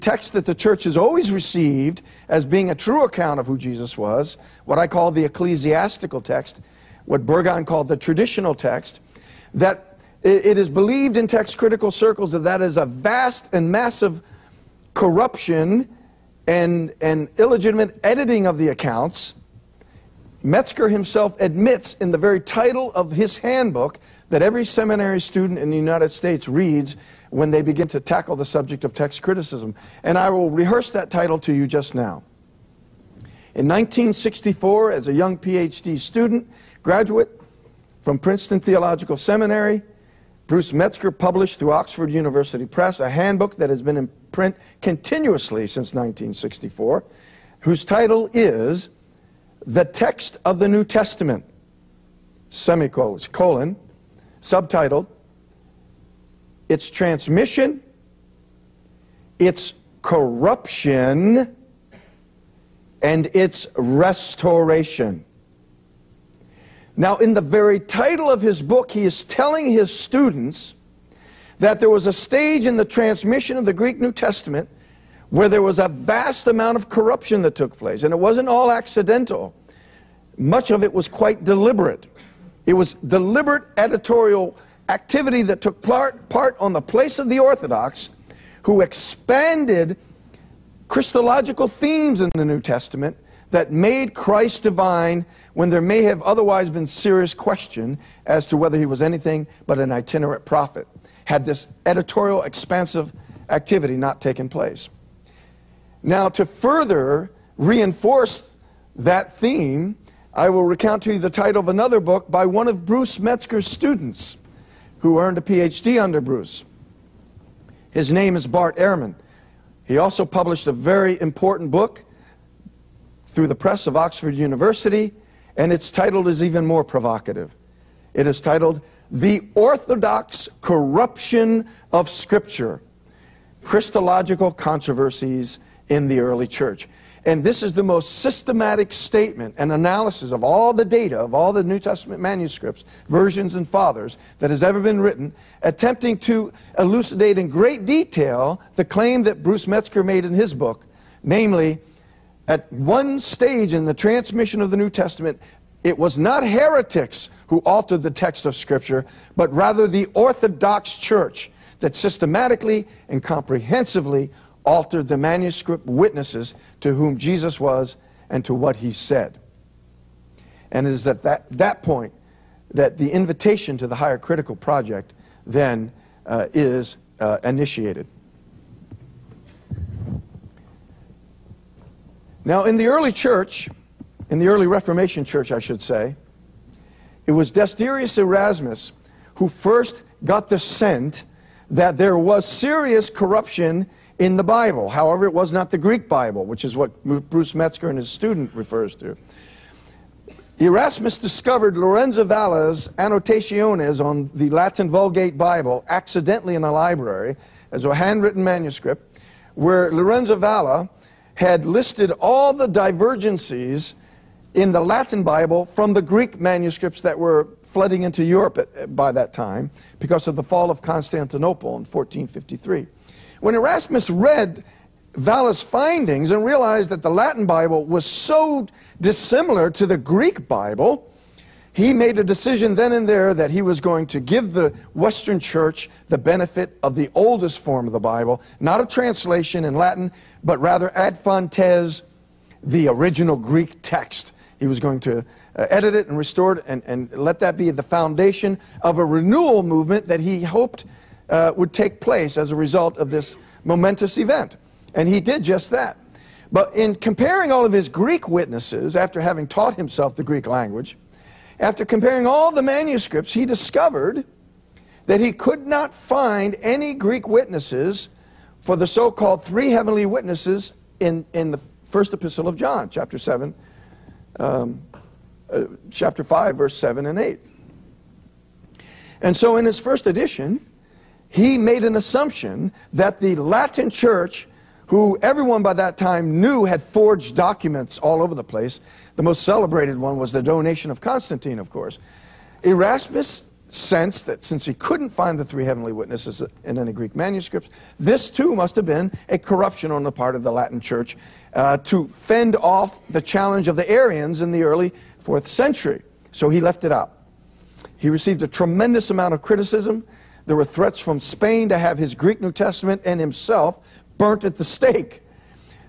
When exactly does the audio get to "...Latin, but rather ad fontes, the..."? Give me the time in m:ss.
3:59.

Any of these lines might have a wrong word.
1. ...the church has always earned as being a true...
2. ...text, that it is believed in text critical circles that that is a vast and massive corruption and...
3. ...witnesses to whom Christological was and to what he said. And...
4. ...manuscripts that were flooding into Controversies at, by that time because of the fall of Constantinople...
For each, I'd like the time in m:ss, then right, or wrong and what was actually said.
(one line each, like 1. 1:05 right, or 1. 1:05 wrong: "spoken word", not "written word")
1. 0:00 wrong: "received", not "earned"
2. 0:08 right
3. 2:45 wrong: "Jesus", not "Christological"
4. 3:36 wrong: "Europe", not "Controversies".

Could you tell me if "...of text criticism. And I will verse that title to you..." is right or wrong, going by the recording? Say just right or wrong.
wrong.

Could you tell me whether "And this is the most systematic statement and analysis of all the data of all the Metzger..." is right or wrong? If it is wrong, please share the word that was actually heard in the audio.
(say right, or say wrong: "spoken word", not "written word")
wrong: "New", not "Metzger".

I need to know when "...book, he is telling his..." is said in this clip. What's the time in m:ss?
1:08.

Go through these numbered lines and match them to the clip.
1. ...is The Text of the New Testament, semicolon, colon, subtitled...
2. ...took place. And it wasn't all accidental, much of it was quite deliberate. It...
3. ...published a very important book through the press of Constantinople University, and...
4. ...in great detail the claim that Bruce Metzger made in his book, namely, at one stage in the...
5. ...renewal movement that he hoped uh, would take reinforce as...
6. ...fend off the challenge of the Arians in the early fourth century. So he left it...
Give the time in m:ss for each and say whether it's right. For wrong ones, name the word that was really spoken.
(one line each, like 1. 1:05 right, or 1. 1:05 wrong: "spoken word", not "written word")
1. 0:48 right
2. 1:17 right
3. 2:00 wrong: "Oxford", not "Constantinople"
4. 2:27 right
5. 4:09 wrong: "place", not "reinforce"
6. 5:02 right.